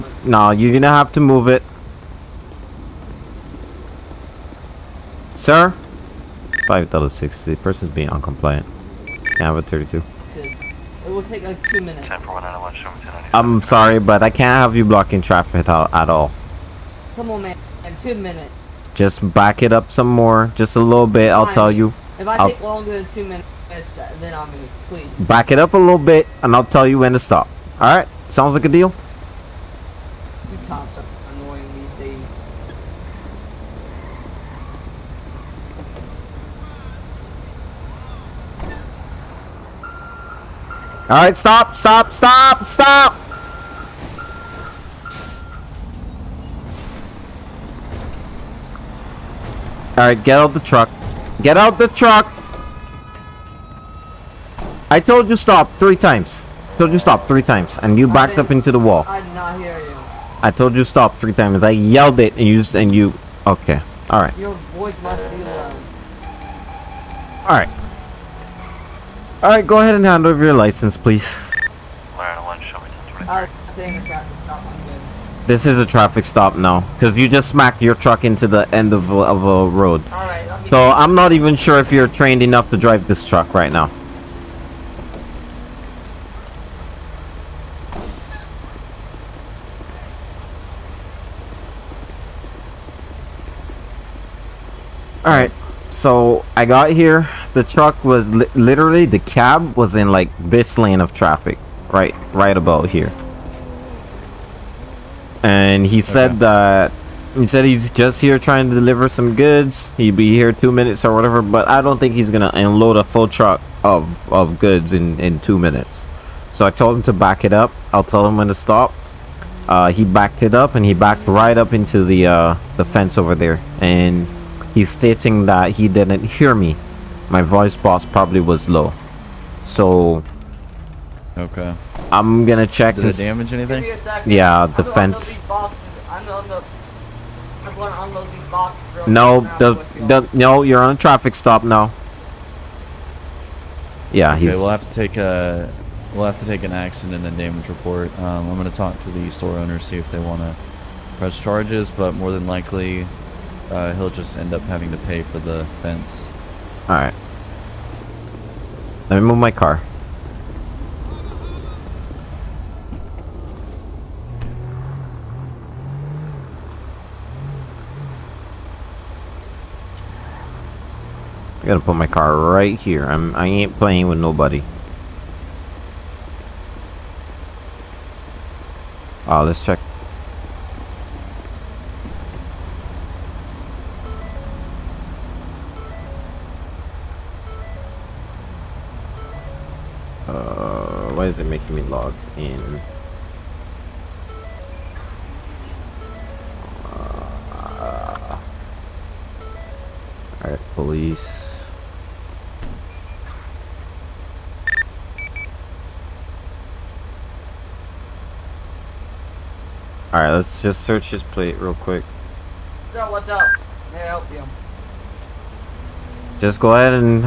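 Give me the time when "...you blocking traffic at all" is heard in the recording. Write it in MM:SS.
00:14.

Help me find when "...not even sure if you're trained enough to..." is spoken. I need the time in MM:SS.
01:21.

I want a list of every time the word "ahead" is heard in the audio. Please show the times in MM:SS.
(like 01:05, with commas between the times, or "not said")
01:09, 03:36.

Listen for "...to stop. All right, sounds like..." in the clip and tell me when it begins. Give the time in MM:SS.
00:27.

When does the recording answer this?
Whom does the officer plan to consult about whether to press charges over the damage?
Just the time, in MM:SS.
02:29.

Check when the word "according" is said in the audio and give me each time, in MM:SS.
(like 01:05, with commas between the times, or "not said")
not said.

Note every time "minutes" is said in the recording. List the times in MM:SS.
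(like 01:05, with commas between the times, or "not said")
00:11, 00:18, 00:23, 01:50, 01:55.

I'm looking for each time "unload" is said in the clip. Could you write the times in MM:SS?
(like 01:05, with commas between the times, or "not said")
01:52, 02:18.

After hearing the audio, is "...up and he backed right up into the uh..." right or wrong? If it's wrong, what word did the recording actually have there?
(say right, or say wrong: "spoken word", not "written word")
right.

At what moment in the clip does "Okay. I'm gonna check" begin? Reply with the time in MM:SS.
02:11.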